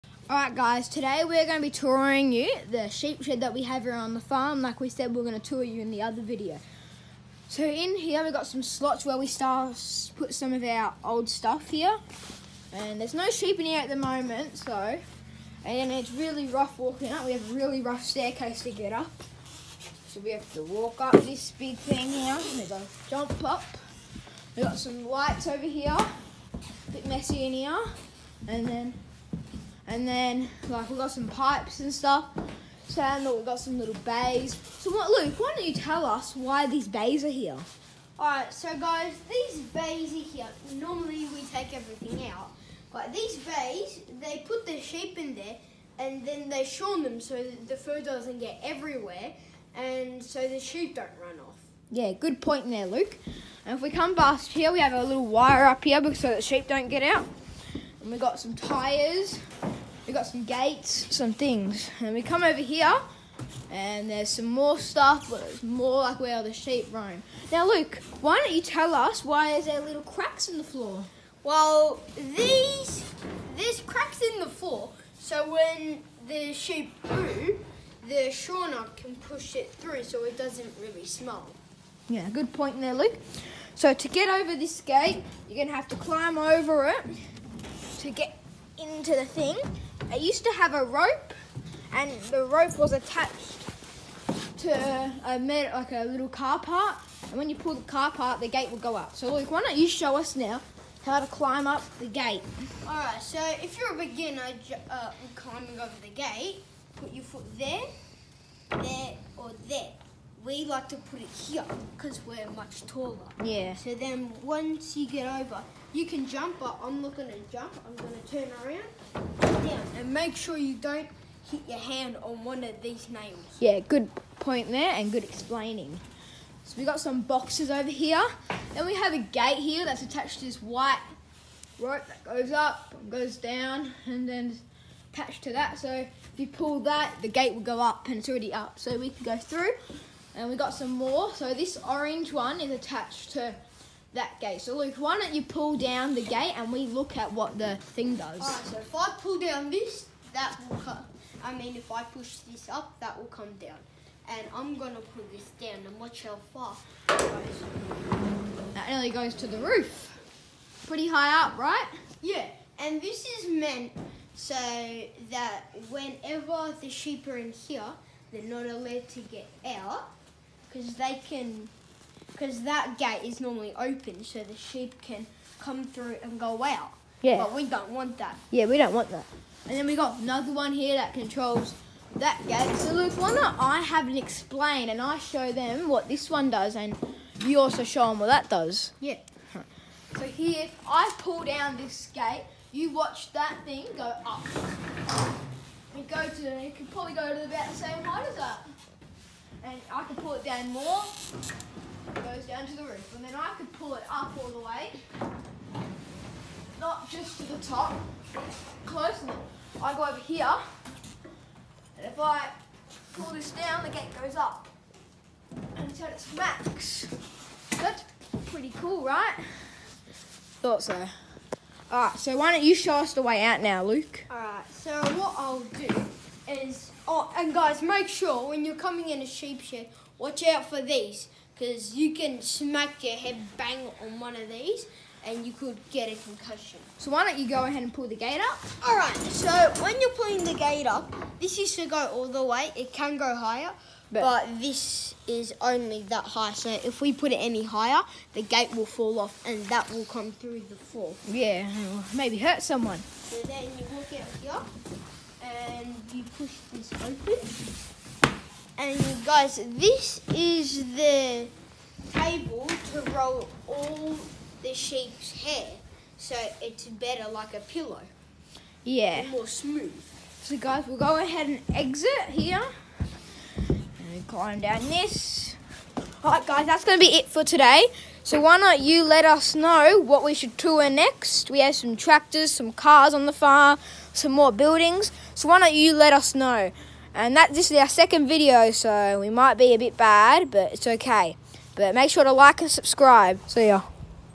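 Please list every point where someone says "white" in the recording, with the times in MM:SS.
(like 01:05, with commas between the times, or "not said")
02:10.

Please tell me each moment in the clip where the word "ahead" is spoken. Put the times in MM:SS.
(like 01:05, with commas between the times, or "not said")
03:57, 04:31.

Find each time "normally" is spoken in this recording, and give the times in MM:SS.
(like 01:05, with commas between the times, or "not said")
00:40, 02:53.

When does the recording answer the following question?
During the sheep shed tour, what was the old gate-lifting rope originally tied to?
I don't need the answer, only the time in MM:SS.
01:35.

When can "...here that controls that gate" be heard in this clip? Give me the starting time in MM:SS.
03:00.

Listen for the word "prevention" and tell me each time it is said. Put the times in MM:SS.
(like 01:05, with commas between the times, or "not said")
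not said.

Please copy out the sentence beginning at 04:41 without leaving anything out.
We have some tractors, some cars on the farm, some more buildings.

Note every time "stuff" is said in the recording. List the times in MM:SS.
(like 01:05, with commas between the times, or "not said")
00:11, 00:31, 01:04.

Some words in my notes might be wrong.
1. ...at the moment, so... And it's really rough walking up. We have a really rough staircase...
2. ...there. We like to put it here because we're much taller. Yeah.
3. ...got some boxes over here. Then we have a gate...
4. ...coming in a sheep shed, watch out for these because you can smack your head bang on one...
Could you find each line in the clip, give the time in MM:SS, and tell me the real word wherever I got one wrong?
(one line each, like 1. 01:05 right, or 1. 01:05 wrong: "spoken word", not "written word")
1. 00:13 right
2. 01:49 right
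3. 02:06 right
4. 03:48 right.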